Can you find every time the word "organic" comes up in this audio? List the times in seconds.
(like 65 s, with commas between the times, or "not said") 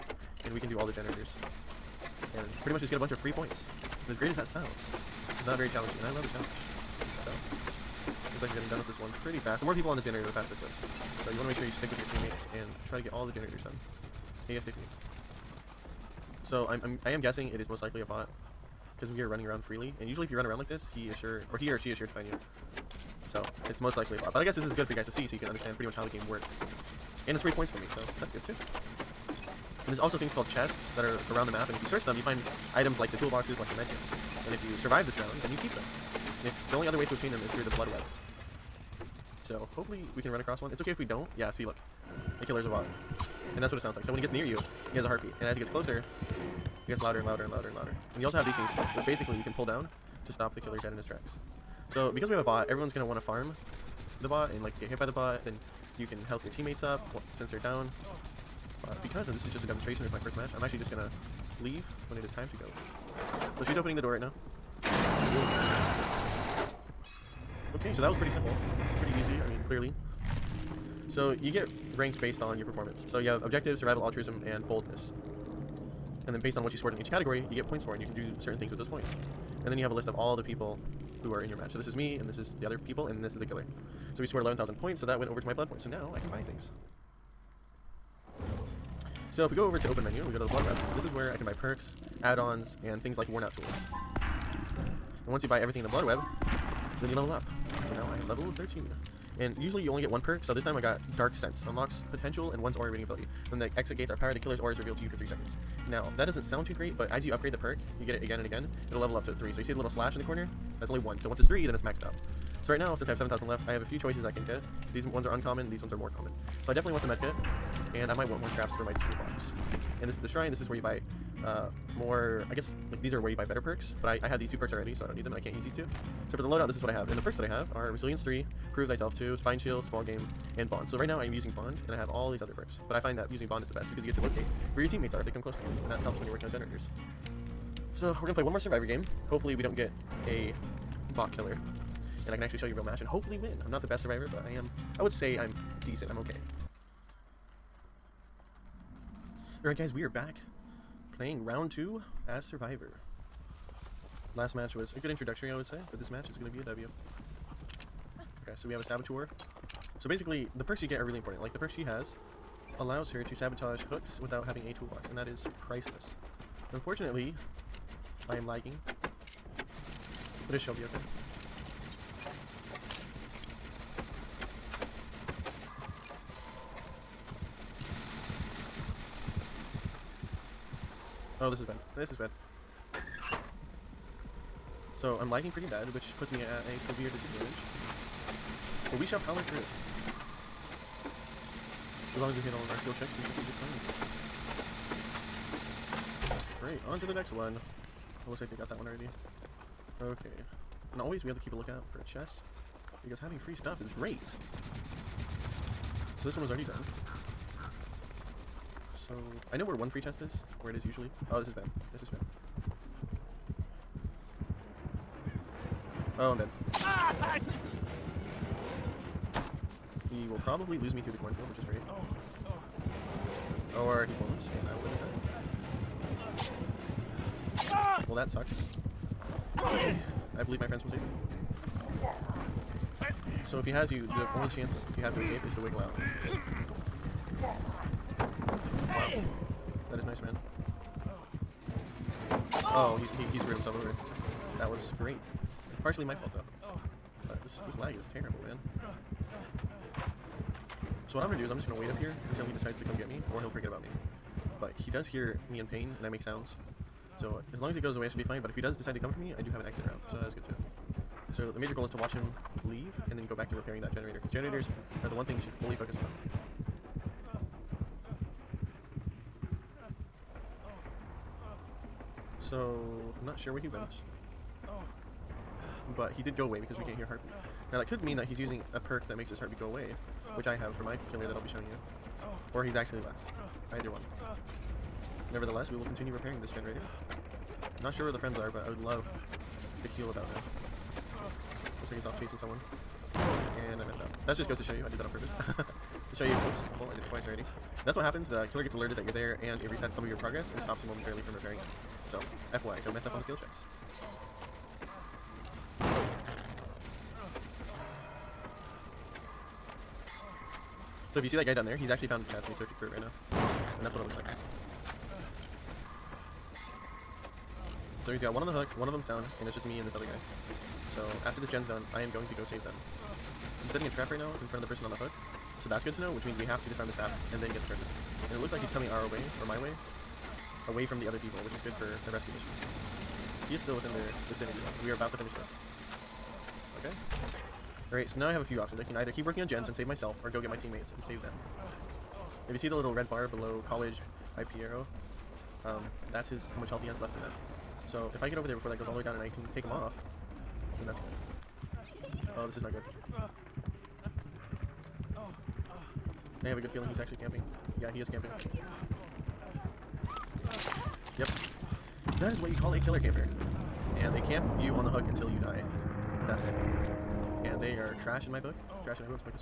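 not said.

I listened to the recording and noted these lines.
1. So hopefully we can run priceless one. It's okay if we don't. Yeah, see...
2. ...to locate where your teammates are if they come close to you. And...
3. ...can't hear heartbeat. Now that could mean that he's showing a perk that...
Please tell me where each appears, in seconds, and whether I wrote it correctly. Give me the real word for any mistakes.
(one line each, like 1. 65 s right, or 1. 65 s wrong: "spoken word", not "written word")
1. 39 s wrong: "across", not "priceless"
2. 134 s right
3. 276 s wrong: "using", not "showing".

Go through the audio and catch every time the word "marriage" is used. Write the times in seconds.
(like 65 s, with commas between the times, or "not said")
not said.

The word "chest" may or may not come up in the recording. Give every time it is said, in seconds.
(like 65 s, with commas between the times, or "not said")
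30 s, 202 s, 210 s, 312 s.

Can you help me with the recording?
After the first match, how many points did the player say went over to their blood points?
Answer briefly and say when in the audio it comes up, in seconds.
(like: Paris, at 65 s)
11,000, at 84 s.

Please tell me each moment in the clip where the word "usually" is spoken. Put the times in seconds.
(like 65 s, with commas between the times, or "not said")
20 s, 99 s, 210 s.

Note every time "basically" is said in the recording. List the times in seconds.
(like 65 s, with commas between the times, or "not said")
49 s, 160 s.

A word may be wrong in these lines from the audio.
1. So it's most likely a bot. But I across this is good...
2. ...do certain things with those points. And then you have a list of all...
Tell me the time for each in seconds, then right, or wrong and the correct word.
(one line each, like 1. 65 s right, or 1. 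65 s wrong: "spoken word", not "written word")
1. 23 s wrong: "guess", not "across"
2. 78 s right.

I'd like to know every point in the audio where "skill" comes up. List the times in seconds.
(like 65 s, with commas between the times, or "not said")
192 s, 303 s.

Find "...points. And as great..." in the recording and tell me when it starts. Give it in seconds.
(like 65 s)
3 s.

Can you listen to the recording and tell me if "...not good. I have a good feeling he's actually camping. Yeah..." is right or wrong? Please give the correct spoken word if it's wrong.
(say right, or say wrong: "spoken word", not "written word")
right.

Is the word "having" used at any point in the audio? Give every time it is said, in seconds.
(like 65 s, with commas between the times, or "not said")
164 s, 203 s.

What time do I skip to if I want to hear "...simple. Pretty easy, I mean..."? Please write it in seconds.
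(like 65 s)
68 s.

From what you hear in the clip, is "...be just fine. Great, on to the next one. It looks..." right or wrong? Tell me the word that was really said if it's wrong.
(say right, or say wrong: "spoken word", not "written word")
right.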